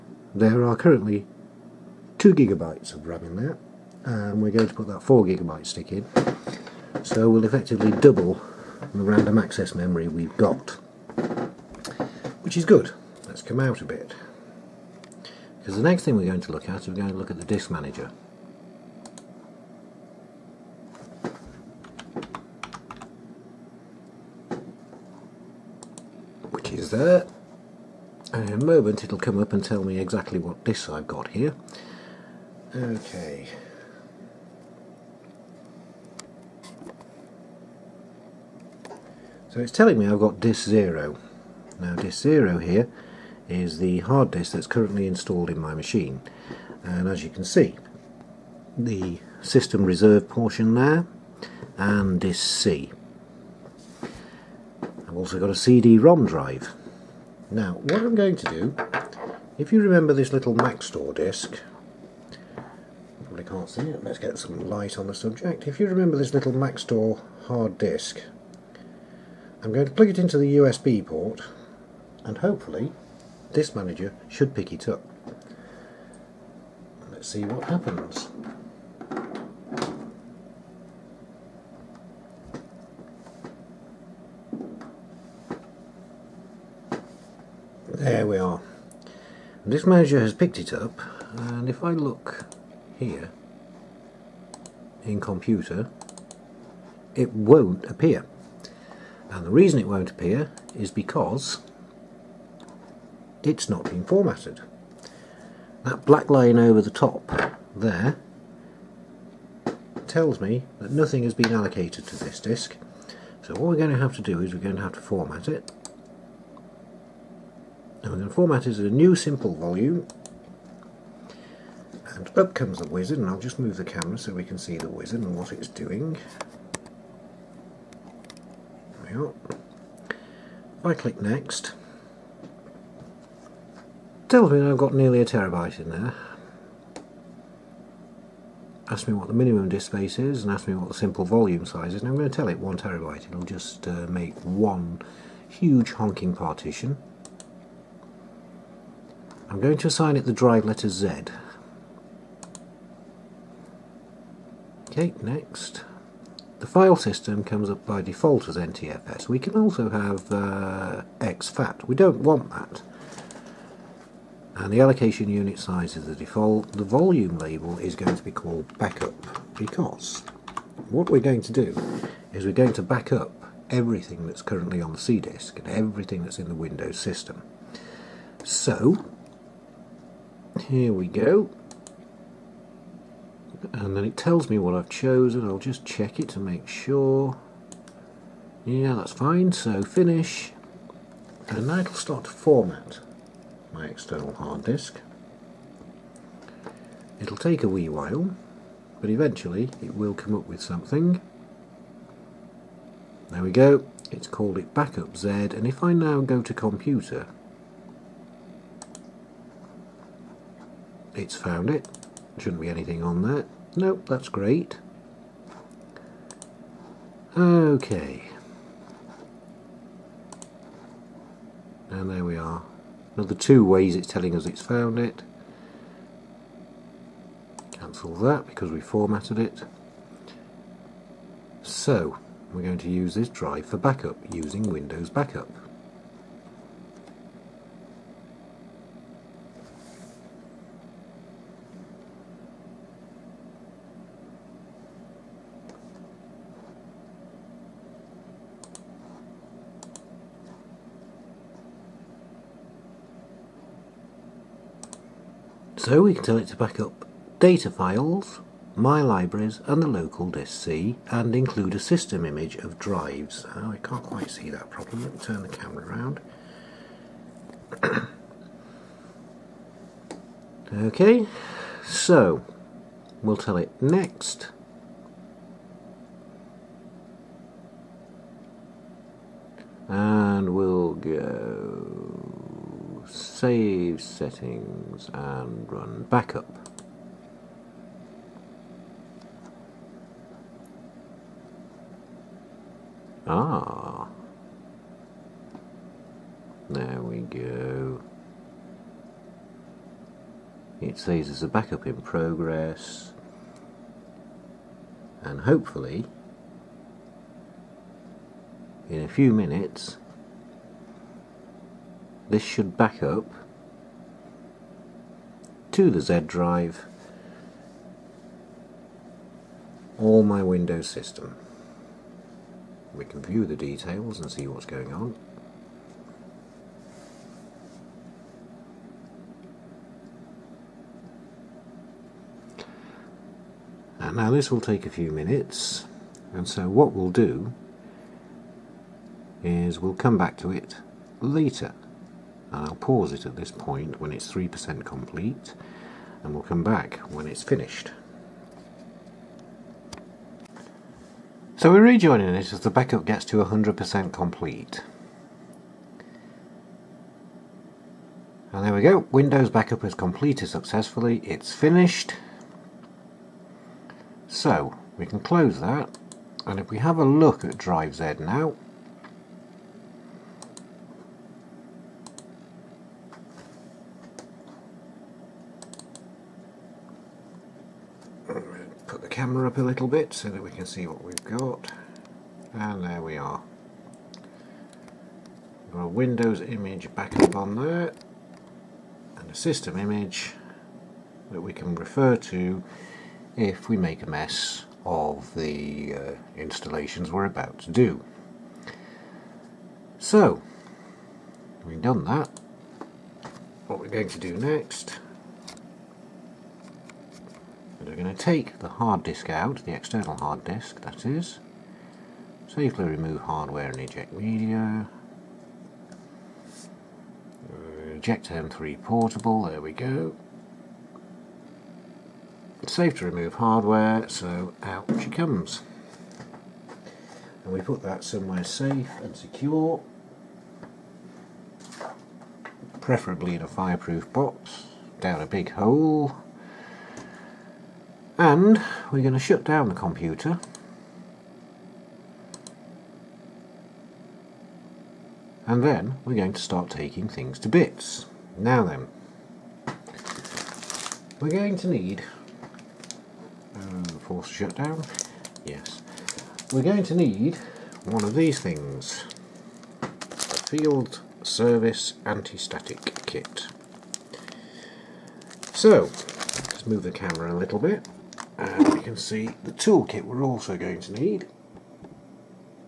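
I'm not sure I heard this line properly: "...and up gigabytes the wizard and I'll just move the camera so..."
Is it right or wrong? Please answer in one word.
wrong.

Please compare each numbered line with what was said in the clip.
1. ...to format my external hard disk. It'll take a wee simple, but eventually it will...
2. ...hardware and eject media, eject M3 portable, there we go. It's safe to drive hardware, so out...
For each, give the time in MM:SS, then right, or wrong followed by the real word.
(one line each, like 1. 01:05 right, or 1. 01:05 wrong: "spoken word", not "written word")
1. 03:12 wrong: "while", not "simple"
2. 06:53 wrong: "remove", not "drive".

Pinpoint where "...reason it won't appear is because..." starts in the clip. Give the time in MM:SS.
01:39.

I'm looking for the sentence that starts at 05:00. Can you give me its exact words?
It says there's a backup in progress.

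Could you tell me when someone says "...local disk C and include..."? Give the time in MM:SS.
04:19.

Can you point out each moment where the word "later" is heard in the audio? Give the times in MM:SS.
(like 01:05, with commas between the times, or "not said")
05:41.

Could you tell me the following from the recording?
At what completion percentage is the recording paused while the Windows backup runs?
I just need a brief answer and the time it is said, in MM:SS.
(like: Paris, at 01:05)
3%, at 05:44.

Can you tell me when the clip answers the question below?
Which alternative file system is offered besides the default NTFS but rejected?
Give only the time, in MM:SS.
02:41.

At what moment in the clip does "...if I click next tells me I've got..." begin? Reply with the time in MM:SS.
02:09.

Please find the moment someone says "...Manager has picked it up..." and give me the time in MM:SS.
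01:29.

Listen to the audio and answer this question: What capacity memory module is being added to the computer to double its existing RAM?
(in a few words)
4 gigabytes.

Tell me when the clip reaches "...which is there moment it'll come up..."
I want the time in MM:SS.
00:26.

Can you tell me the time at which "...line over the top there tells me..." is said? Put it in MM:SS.
01:46.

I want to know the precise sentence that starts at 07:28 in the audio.
Now then, we're going to need uh, force shutdown, yes, we're going to need one of these things, field service anti-static kit.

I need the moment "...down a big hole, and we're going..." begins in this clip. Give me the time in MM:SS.
07:15.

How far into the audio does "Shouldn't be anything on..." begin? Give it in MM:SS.
03:32.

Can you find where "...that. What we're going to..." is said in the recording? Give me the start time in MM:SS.
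06:42.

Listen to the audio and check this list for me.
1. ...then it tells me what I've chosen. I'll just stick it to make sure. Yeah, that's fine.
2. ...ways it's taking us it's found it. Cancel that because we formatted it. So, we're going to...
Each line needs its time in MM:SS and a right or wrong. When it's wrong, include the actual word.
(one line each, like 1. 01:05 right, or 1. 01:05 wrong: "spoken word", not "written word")
1. 03:03 wrong: "check", not "stick"
2. 03:43 wrong: "telling", not "taking".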